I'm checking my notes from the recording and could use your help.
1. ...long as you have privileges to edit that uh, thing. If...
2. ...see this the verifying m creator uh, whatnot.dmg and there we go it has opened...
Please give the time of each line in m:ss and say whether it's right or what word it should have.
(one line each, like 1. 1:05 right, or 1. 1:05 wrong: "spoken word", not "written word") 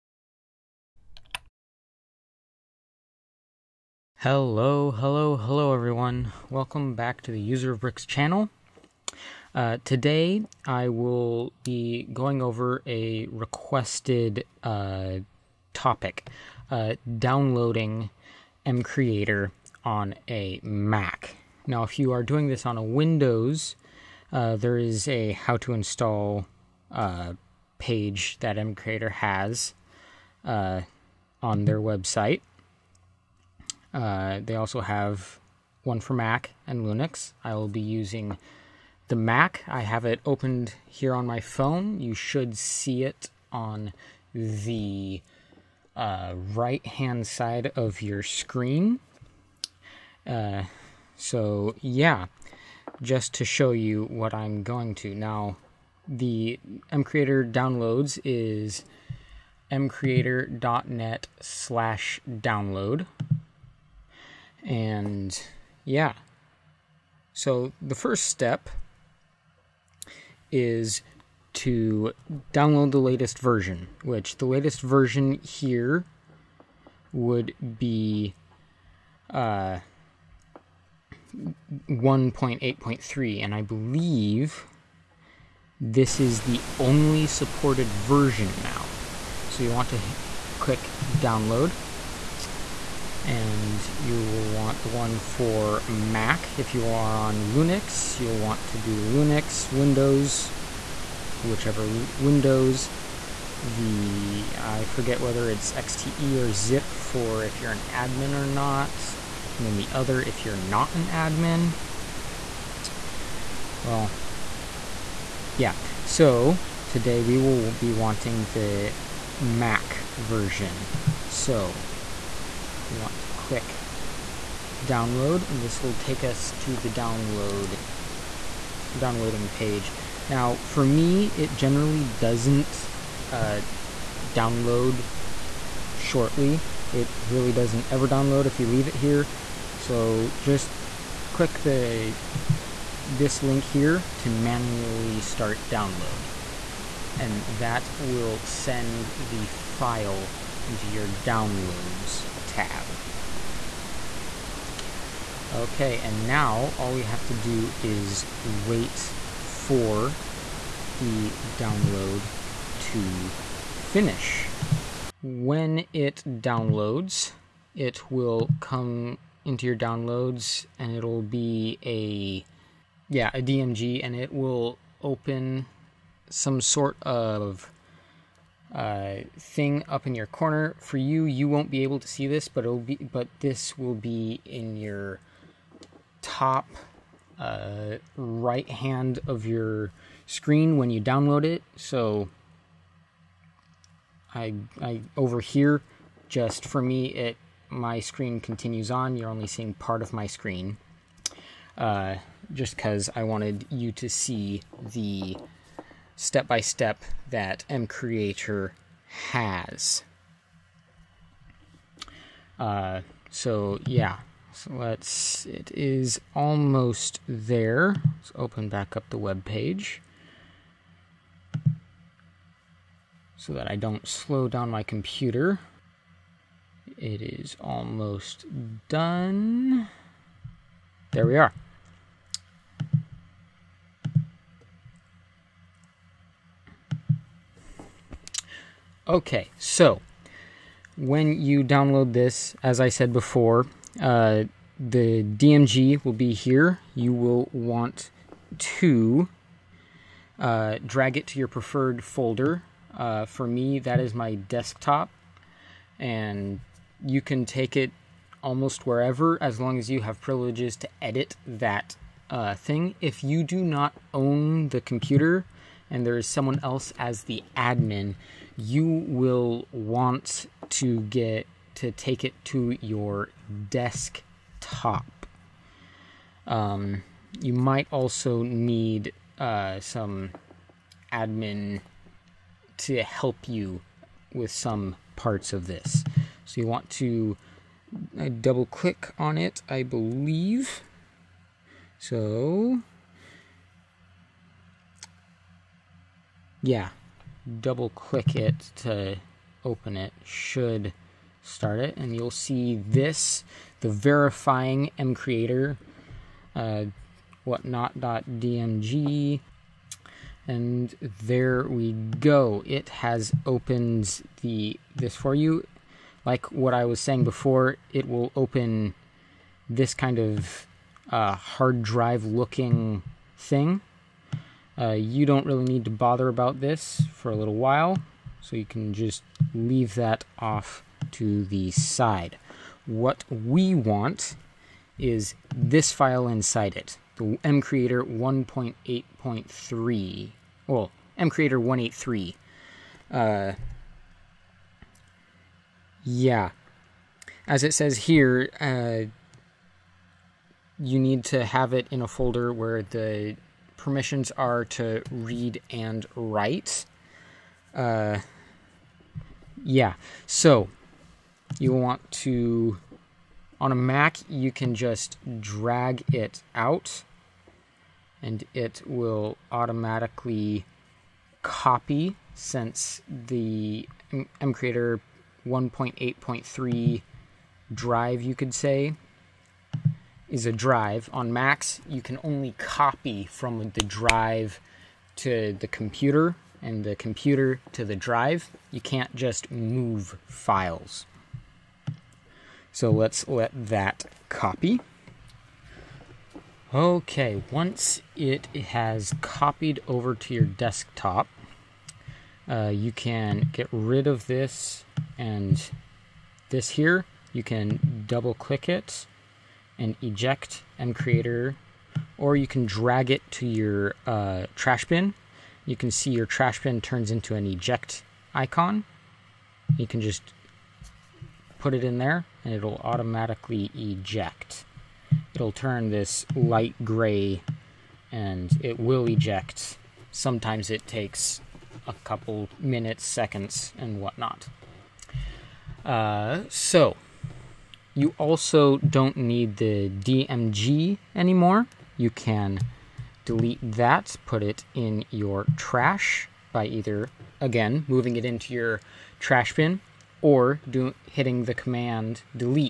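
1. 4:19 right
2. 5:02 right.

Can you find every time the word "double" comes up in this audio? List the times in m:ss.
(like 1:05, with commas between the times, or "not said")
4:48, 4:57, 6:48.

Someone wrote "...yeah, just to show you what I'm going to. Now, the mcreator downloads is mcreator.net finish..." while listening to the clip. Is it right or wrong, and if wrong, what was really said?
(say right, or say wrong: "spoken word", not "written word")
wrong: "slash", not "finish".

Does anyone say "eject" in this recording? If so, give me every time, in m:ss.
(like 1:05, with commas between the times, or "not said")
6:50, 6:57, 7:03, 7:09.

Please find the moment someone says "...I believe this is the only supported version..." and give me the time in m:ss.
1:23.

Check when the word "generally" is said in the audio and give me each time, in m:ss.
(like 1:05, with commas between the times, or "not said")
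2:11.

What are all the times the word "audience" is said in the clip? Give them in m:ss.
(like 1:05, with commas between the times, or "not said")
not said.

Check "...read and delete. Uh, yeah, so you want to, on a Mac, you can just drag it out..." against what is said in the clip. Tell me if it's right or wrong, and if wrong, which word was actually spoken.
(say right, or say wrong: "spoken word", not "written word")
wrong: "write", not "delete".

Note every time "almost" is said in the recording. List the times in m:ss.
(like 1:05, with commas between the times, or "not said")
3:36, 3:47, 4:18.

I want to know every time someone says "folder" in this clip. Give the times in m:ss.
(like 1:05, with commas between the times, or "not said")
4:12, 5:52.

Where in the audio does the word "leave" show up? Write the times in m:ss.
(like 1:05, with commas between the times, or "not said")
2:18, 5:29.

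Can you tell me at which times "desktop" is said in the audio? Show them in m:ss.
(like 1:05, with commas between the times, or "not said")
4:14, 4:33, 6:40.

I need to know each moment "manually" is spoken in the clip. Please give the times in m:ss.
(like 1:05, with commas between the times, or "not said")
2:24.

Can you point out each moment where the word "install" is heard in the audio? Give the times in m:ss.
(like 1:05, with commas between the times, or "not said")
0:25.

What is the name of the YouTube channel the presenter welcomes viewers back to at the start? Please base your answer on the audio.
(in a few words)
User of Bricks.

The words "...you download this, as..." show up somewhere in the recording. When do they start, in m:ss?
4:01.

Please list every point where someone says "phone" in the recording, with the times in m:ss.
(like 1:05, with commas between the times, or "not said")
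0:41.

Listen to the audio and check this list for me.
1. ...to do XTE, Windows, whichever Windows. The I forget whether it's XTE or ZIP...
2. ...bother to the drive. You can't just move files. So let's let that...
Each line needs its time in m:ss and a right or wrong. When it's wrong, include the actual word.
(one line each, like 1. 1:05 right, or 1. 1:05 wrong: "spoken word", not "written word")
1. 1:38 wrong: "Linux", not "XTE"
2. 6:26 wrong: "computer", not "bother".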